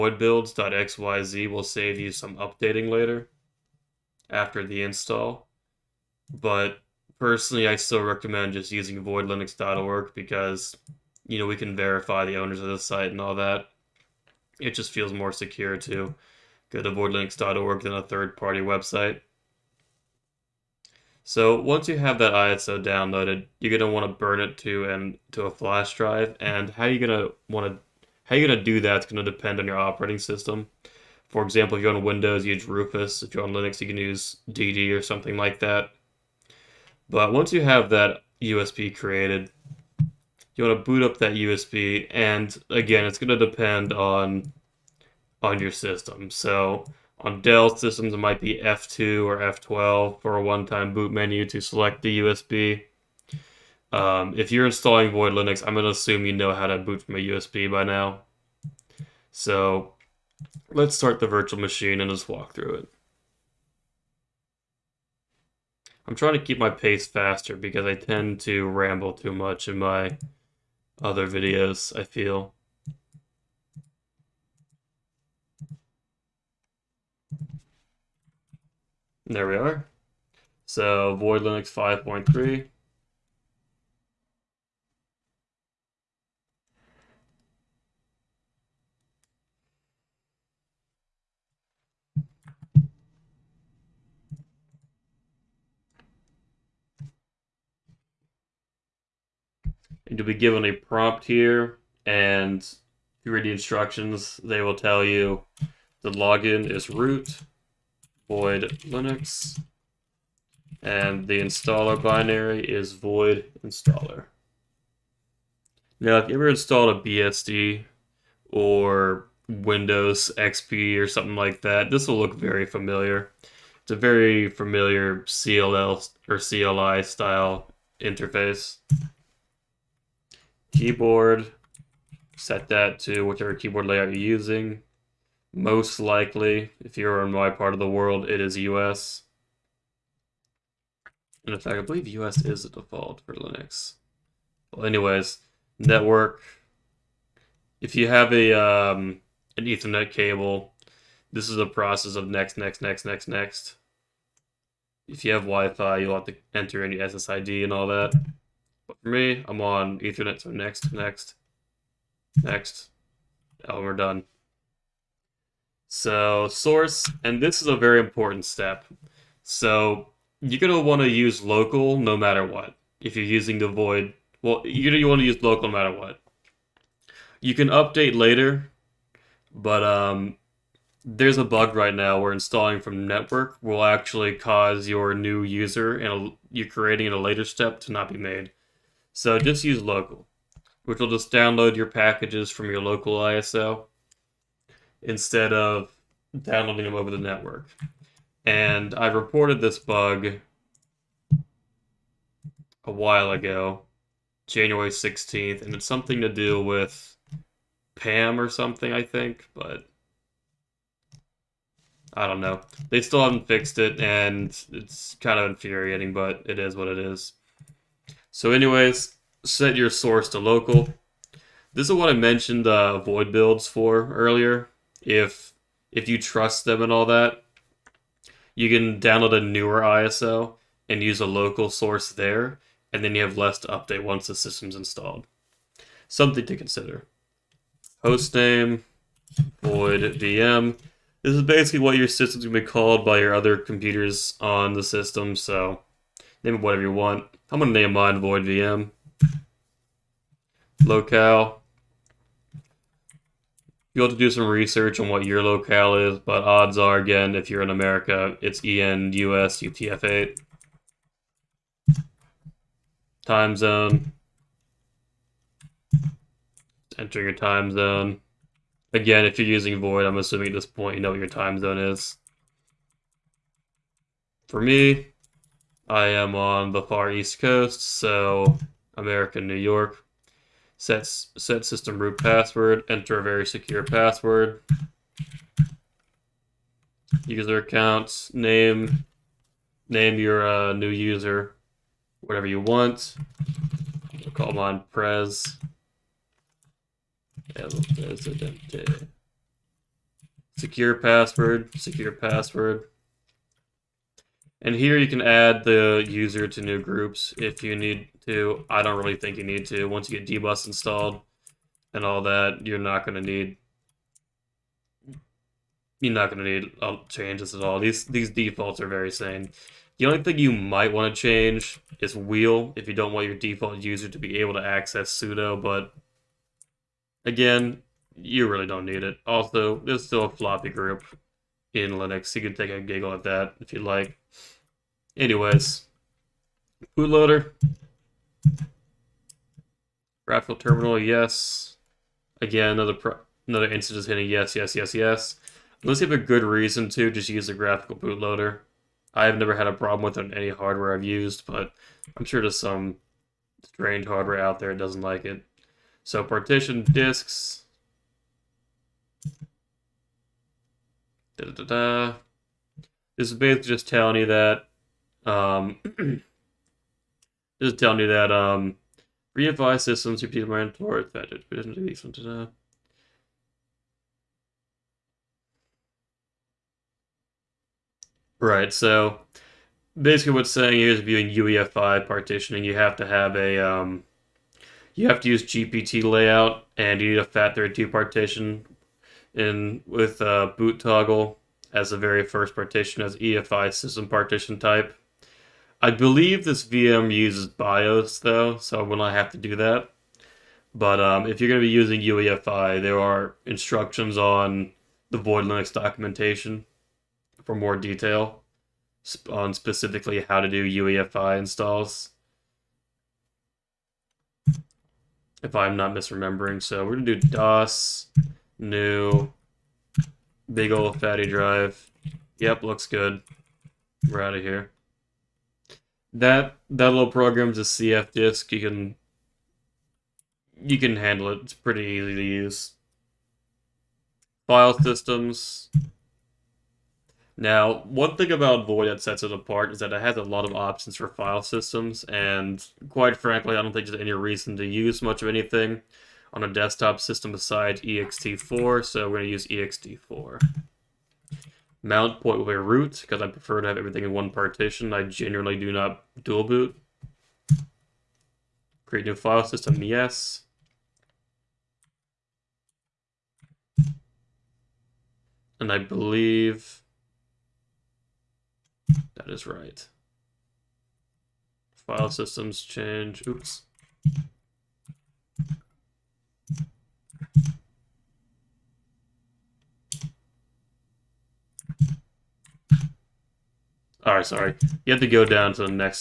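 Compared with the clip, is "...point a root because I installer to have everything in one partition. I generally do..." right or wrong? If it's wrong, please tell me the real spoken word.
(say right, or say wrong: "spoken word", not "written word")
wrong: "prefer", not "installer".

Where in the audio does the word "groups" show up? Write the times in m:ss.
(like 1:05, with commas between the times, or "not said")
5:06, 5:30.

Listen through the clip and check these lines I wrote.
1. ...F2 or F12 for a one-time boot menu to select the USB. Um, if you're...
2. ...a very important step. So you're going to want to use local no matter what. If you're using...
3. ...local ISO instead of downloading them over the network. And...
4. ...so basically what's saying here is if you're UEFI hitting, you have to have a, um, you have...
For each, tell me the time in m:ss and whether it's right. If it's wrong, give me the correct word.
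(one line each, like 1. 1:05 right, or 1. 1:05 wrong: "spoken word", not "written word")
1. 0:48 right
2. 2:47 right
3. 3:12 right
4. 6:18 wrong: "partitioning", not "hitting".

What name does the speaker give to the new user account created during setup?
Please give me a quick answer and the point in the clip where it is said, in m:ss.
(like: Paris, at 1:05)
Prez, at 4:54.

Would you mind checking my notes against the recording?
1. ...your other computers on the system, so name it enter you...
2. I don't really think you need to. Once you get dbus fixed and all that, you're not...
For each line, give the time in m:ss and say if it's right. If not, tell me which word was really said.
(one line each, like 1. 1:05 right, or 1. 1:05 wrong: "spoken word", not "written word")
1. 4:03 wrong: "whatever", not "enter"
2. 5:08 wrong: "installed", not "fixed".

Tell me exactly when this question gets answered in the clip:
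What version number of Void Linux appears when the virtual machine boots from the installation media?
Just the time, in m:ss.
1:21.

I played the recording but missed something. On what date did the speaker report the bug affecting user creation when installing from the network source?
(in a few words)
January 16th.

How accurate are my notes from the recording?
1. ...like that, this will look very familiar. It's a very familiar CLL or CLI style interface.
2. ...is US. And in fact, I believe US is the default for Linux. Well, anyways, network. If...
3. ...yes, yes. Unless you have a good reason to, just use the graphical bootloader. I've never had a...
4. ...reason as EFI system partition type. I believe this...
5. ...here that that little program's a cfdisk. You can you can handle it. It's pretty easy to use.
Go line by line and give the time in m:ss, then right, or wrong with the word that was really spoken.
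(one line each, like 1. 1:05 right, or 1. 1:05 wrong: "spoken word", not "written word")
1. 2:01 right
2. 2:18 right
3. 5:44 right
4. 6:32 wrong: "partition", not "reason"
5. 7:04 right.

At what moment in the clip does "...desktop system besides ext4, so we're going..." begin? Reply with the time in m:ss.
7:26.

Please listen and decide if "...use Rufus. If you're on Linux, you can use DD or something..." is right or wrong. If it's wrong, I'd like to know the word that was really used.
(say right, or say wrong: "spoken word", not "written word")
right.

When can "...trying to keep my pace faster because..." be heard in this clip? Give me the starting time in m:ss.
1:06.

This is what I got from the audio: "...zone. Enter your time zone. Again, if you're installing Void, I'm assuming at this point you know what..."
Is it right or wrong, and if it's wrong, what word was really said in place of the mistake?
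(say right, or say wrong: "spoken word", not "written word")
wrong: "using", not "installing".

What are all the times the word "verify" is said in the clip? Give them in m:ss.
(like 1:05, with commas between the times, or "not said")
0:11.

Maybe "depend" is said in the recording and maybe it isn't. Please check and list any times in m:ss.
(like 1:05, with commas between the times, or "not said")
0:29, 0:43.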